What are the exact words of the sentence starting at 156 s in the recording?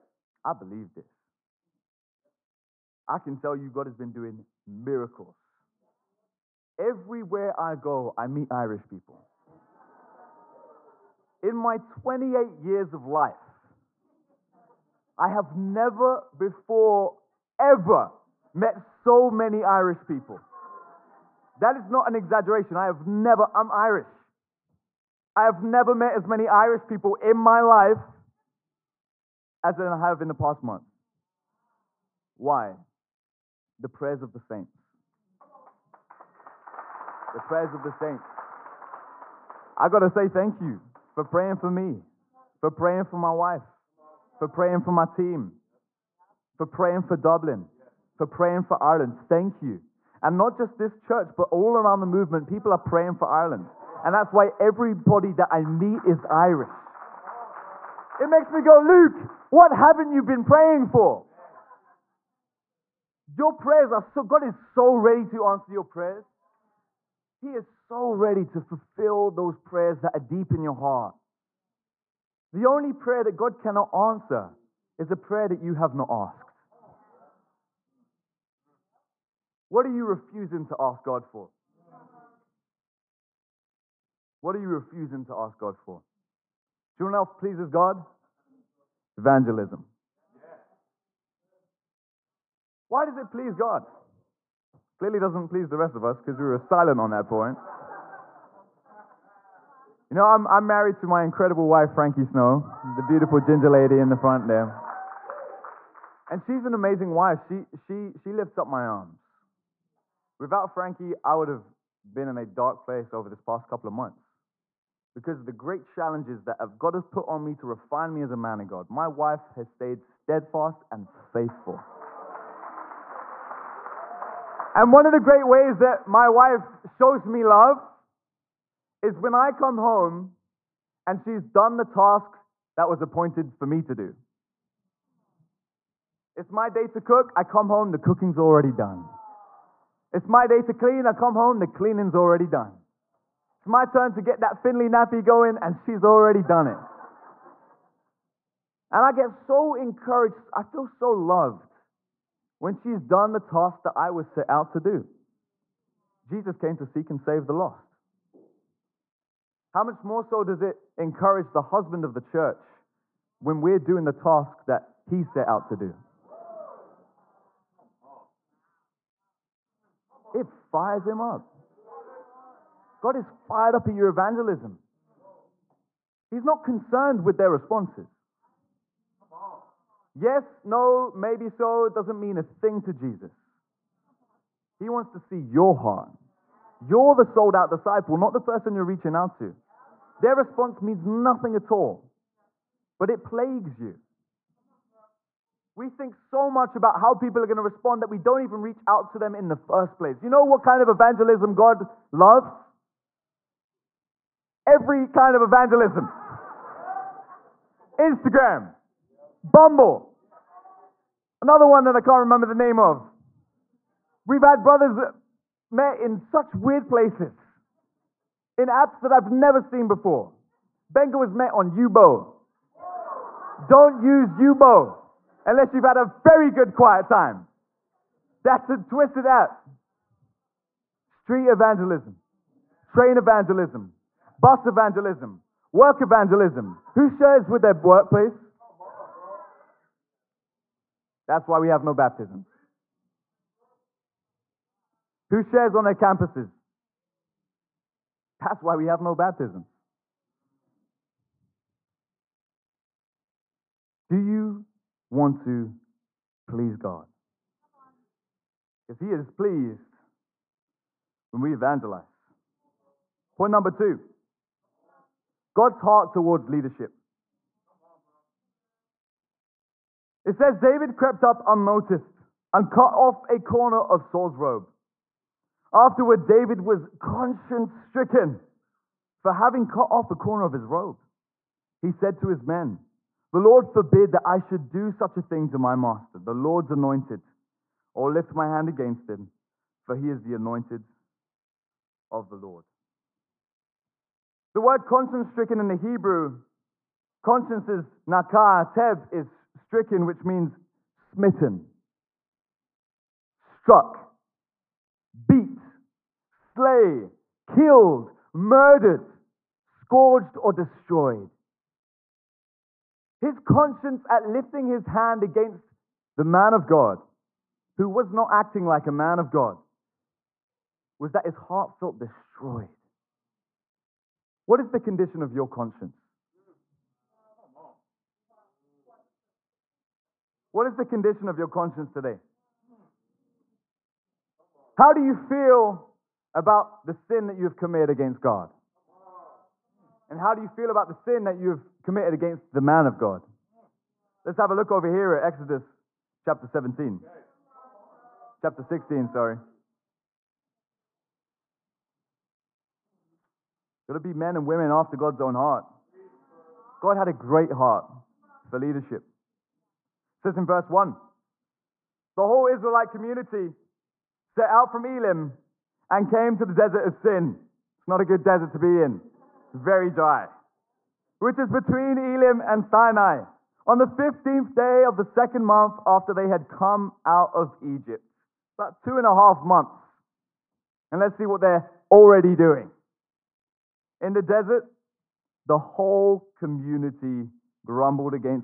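Jesus came to seek and save the lost.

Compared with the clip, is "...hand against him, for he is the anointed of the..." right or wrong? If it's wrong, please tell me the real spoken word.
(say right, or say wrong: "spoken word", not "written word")
right.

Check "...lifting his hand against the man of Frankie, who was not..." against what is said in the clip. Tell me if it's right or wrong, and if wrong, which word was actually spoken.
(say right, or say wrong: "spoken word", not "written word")
wrong: "God", not "Frankie".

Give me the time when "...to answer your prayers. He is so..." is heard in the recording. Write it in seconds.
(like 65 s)
65 s.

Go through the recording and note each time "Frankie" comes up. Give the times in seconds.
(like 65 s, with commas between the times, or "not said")
101 s, 110 s.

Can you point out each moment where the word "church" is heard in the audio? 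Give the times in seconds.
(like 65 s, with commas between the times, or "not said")
50 s, 162 s.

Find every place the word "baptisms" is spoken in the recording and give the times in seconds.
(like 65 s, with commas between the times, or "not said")
241 s, 249 s.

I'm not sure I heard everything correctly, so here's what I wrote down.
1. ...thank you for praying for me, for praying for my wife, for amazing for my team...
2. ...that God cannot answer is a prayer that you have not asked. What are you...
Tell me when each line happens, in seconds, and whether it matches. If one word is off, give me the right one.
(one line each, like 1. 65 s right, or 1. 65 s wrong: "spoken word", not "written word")
1. 40 s wrong: "praying", not "amazing"
2. 73 s right.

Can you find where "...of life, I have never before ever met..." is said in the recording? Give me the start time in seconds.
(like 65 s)
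12 s.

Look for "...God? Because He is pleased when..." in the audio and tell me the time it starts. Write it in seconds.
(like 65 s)
256 s.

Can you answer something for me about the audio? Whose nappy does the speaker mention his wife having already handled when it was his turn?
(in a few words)
Finley.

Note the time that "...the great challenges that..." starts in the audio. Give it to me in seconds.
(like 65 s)
115 s.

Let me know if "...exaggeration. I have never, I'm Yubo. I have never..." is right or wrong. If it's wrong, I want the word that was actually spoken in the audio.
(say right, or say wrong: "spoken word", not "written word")
wrong: "Irish", not "Yubo".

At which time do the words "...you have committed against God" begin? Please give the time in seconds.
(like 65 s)
337 s.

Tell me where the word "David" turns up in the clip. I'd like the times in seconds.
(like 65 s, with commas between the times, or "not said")
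270 s, 276 s.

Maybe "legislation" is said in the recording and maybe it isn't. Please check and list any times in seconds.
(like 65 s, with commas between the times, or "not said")
not said.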